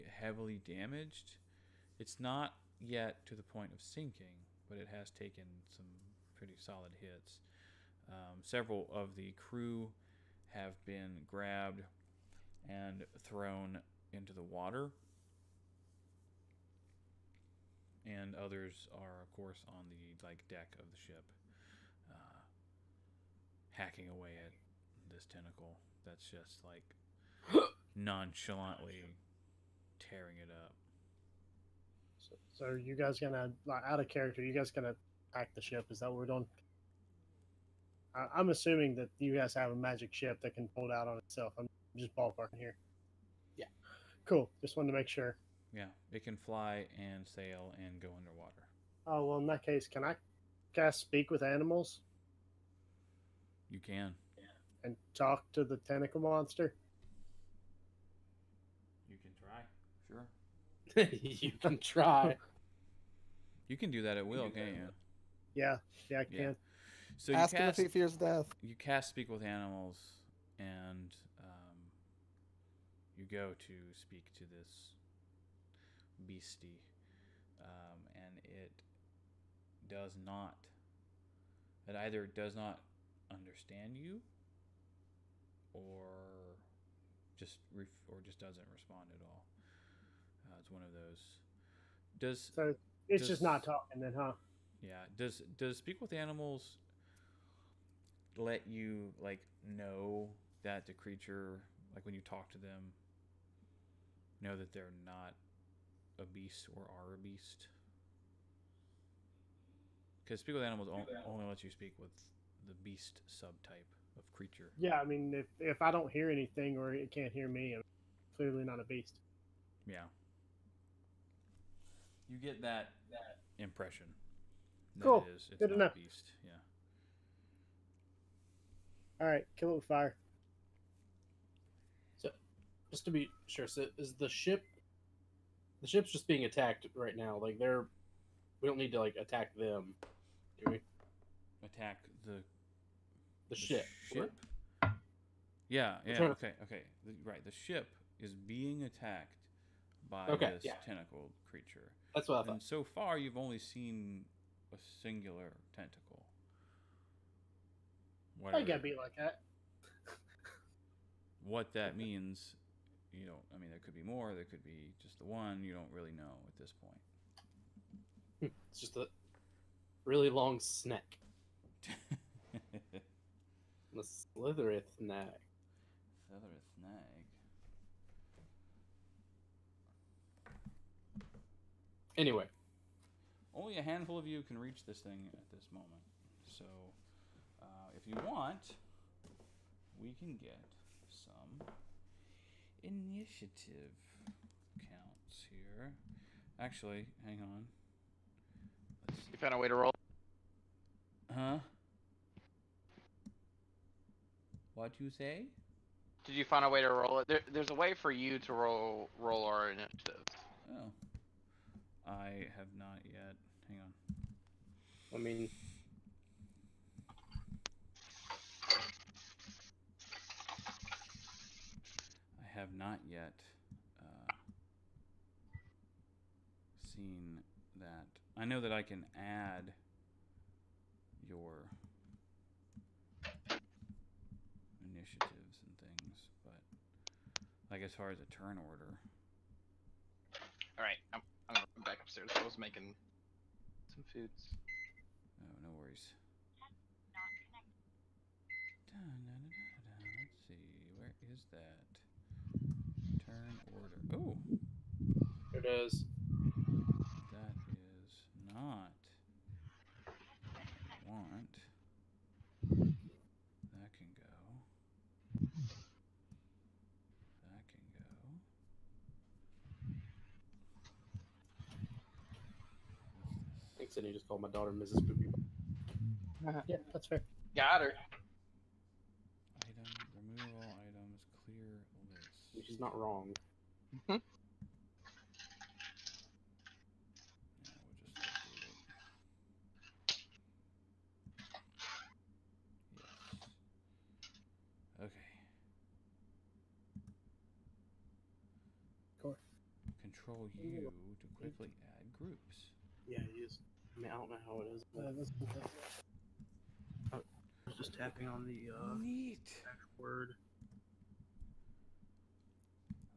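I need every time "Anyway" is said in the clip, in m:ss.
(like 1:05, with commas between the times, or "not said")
3:02.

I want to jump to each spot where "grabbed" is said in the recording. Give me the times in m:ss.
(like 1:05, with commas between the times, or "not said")
0:11.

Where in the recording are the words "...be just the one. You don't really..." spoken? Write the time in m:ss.
2:44.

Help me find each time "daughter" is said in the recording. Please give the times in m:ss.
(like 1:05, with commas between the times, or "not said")
4:34.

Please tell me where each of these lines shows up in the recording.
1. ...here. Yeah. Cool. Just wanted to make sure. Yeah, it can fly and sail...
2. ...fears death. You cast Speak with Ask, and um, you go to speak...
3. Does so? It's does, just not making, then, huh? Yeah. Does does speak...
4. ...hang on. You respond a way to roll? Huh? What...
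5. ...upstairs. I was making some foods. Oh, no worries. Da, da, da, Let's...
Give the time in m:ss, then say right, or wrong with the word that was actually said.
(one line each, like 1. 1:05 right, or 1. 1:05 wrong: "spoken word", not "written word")
1. 0:42 right
2. 1:07 wrong: "Animals", not "Ask"
3. 1:32 wrong: "talking", not "making"
4. 3:17 wrong: "found", not "respond"
5. 4:02 right.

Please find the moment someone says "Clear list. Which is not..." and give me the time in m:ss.
4:41.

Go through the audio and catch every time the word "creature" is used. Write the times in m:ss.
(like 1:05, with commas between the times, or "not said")
1:40, 1:54, 2:31.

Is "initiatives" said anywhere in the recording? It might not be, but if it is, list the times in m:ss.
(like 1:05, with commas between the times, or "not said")
3:12, 3:29, 3:54.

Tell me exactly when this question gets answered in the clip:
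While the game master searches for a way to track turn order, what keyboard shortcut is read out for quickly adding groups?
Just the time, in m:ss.
5:00.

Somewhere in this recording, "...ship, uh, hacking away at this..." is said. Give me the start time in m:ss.
0:21.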